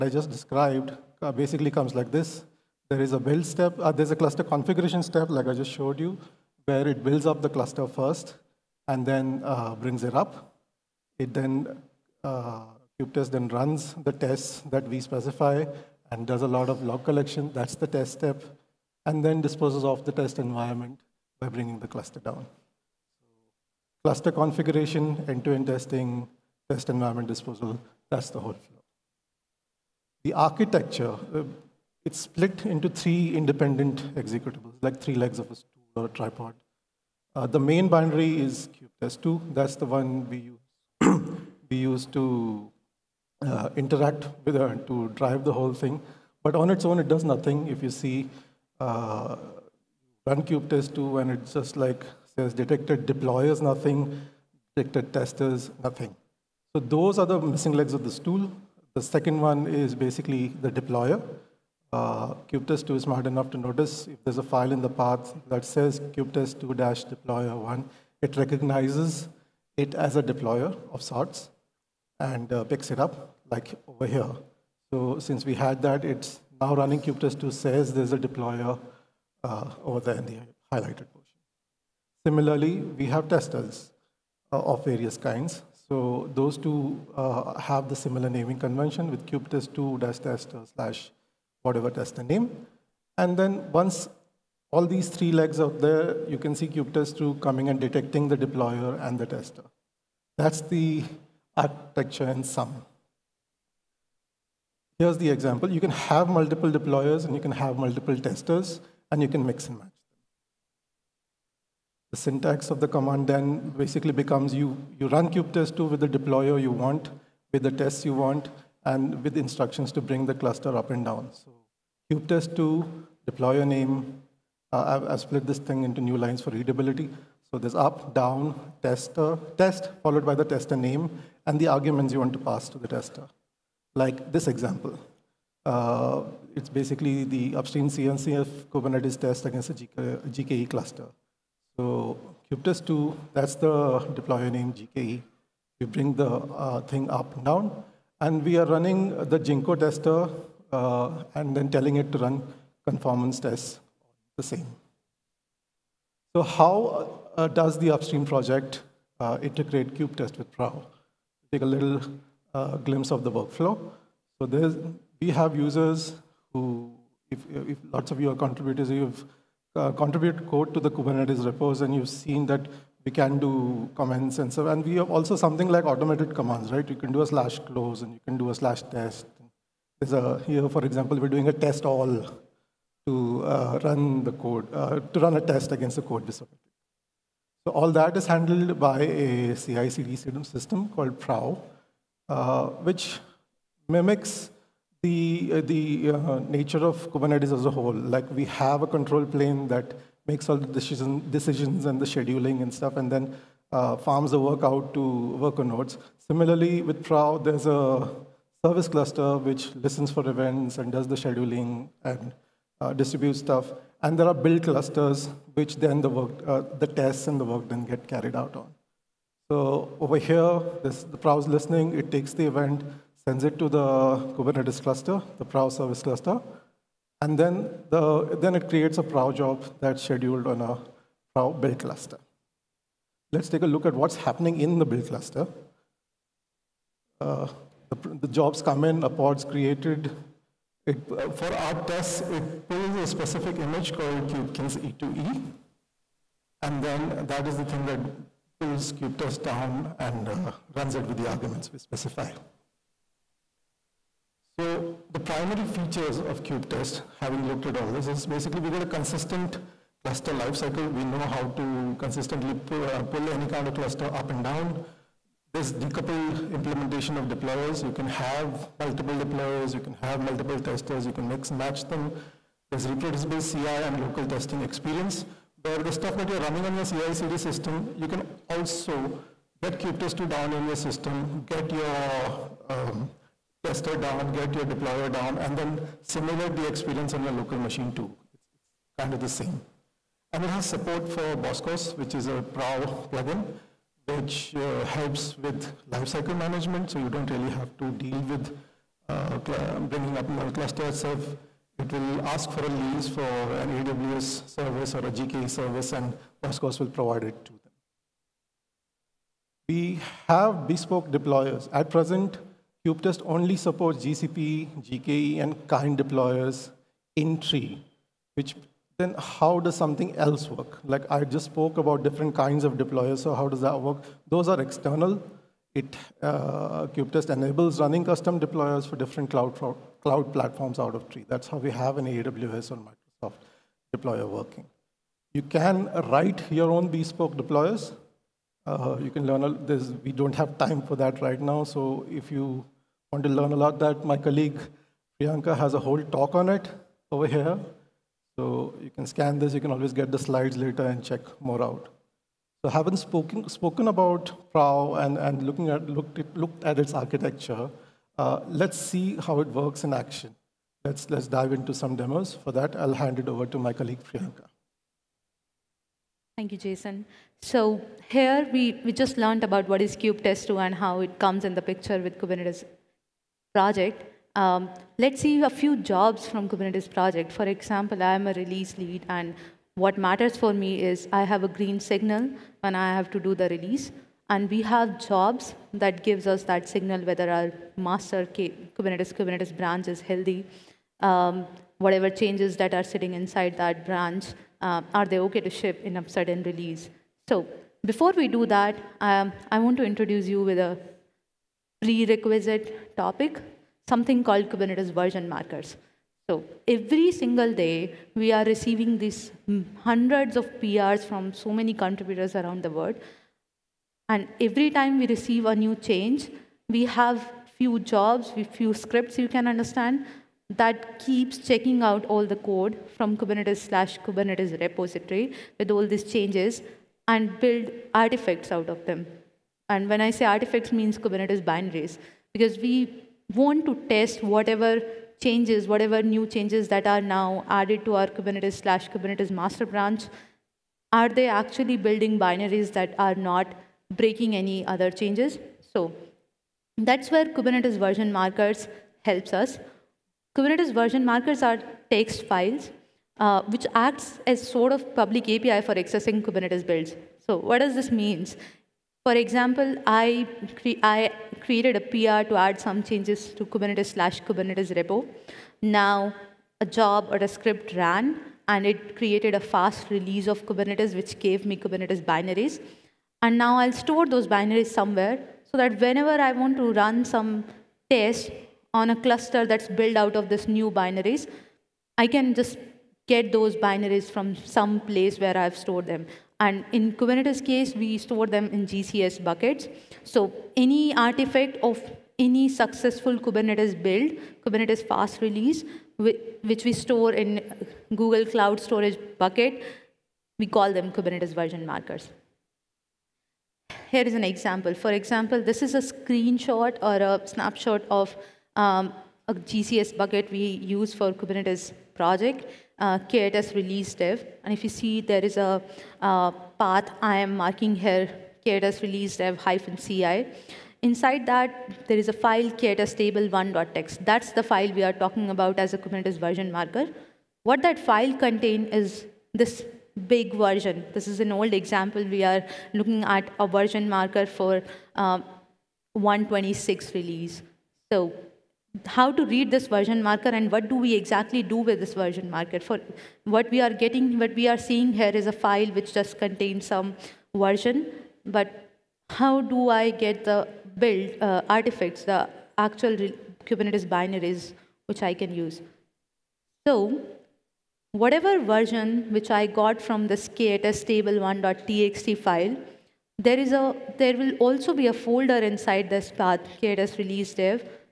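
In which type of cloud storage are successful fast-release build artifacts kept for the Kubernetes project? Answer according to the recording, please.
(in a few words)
GCS buckets.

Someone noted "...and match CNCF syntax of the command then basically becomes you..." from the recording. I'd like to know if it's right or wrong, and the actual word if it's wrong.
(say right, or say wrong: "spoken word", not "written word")
wrong: "The", not "CNCF".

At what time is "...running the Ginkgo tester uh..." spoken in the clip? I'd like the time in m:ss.
2:28.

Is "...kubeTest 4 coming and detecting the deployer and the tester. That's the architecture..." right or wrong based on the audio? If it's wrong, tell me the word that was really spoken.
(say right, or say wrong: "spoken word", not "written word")
wrong: "2", not "4".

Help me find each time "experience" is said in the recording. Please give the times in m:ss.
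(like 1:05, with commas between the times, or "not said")
4:34, 4:46.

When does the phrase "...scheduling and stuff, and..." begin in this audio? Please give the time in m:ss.
3:22.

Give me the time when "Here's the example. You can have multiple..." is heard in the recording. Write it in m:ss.
1:44.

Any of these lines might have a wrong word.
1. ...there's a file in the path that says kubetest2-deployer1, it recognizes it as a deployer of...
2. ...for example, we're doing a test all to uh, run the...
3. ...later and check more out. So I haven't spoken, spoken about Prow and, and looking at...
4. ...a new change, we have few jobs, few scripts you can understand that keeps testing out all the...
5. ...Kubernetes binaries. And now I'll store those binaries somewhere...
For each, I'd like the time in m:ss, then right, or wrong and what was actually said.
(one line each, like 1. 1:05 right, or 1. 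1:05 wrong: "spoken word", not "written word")
1. 1:04 right
2. 3:00 right
3. 5:50 right
4. 6:55 wrong: "checking", not "testing"
5. 7:51 right.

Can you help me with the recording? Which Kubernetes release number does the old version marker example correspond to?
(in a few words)
1.26.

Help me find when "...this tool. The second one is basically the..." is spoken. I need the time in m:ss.
0:58.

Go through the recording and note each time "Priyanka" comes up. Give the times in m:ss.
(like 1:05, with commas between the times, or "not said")
5:45, 6:04.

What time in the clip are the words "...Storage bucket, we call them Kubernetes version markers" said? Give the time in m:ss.
8:18.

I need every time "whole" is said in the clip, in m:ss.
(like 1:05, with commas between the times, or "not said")
0:28, 0:45, 3:17, 5:45.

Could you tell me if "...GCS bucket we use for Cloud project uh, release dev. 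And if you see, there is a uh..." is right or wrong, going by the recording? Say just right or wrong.
wrong.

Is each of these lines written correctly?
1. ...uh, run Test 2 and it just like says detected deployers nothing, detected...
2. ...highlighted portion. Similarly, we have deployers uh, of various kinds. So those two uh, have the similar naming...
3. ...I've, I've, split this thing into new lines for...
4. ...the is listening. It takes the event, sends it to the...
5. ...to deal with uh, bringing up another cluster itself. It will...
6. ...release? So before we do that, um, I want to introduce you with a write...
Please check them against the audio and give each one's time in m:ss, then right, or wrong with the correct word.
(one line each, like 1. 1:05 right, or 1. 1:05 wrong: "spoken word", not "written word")
1. 0:48 right
2. 1:20 wrong: "testers", not "deployers"
3. 2:04 right
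4. 3:41 right
5. 4:57 right
6. 6:36 wrong: "prerequisite", not "write".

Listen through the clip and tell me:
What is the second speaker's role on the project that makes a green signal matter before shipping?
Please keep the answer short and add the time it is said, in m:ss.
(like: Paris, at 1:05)
release lead, at 6:18.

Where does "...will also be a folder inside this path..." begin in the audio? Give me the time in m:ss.
9:24.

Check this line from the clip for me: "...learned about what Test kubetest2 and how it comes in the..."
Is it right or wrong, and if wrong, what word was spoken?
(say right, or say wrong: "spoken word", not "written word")
right.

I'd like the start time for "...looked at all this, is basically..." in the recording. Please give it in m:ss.
4:17.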